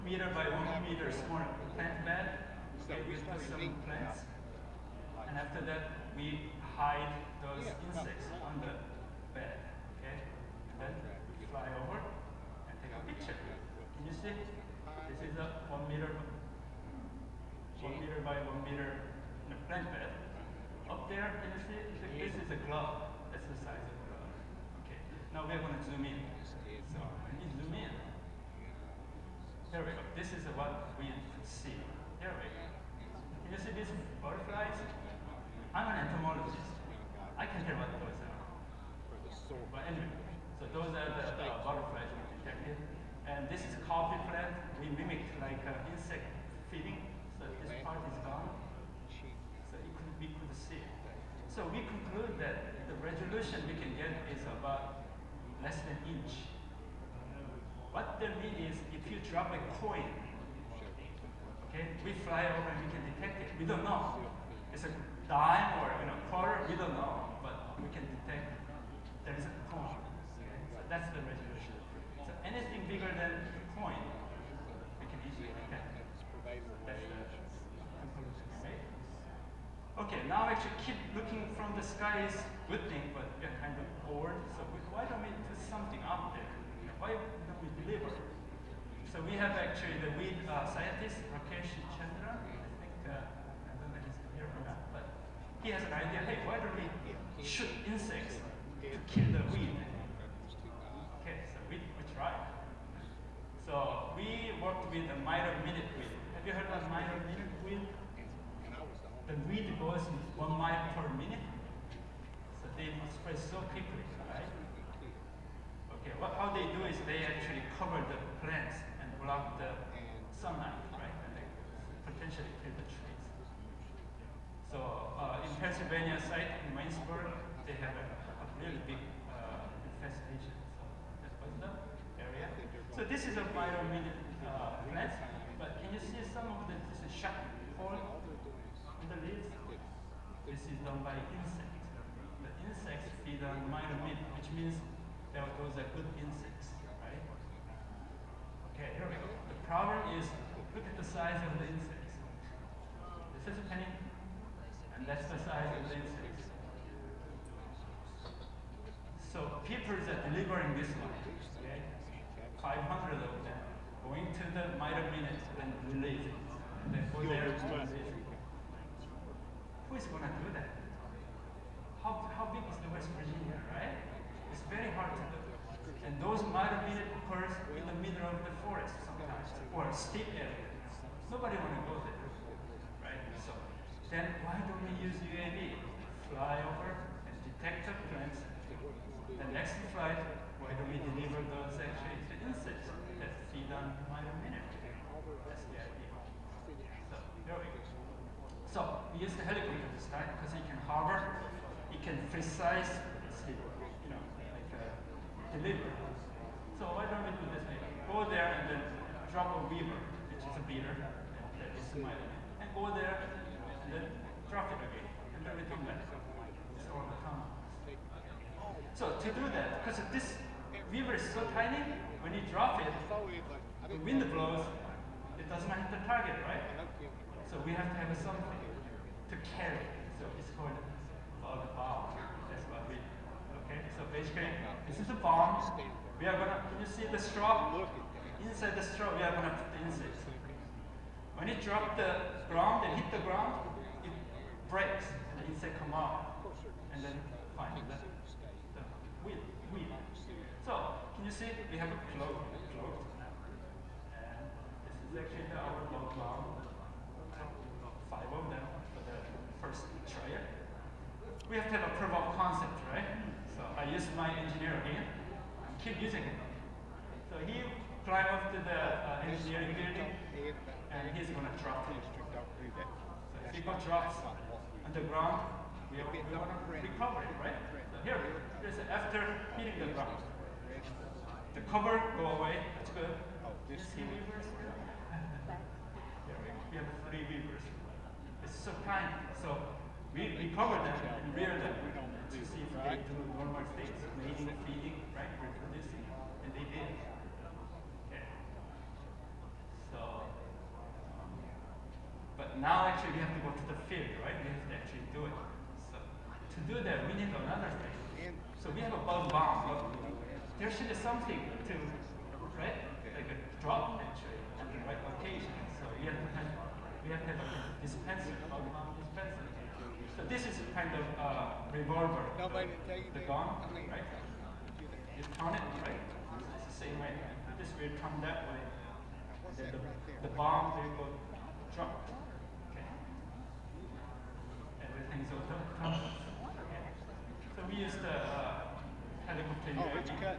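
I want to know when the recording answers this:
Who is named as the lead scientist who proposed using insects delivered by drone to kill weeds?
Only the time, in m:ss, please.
1:31.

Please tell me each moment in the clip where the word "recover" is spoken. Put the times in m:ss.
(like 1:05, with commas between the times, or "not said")
4:36.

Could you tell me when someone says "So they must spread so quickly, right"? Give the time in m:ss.
1:52.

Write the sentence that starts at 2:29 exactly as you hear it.
The problem is, look at the size of the insects.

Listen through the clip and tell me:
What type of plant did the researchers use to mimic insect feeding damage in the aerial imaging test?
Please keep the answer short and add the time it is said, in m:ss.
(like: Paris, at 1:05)
Coffee plant, at 0:43.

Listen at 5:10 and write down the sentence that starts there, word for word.
There should be something to, right?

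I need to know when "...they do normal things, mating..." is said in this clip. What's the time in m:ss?
4:52.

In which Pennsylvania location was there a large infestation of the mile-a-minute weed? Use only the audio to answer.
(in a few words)
Waynesburg.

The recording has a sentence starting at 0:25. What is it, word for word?
Now we're going to zoom in.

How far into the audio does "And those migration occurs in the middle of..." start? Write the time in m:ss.
2:56.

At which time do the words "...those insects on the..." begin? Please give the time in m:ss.
0:07.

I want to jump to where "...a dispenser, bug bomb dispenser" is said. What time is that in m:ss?
5:17.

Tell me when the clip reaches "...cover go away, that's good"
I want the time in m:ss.
4:41.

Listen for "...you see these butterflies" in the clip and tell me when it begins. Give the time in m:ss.
0:33.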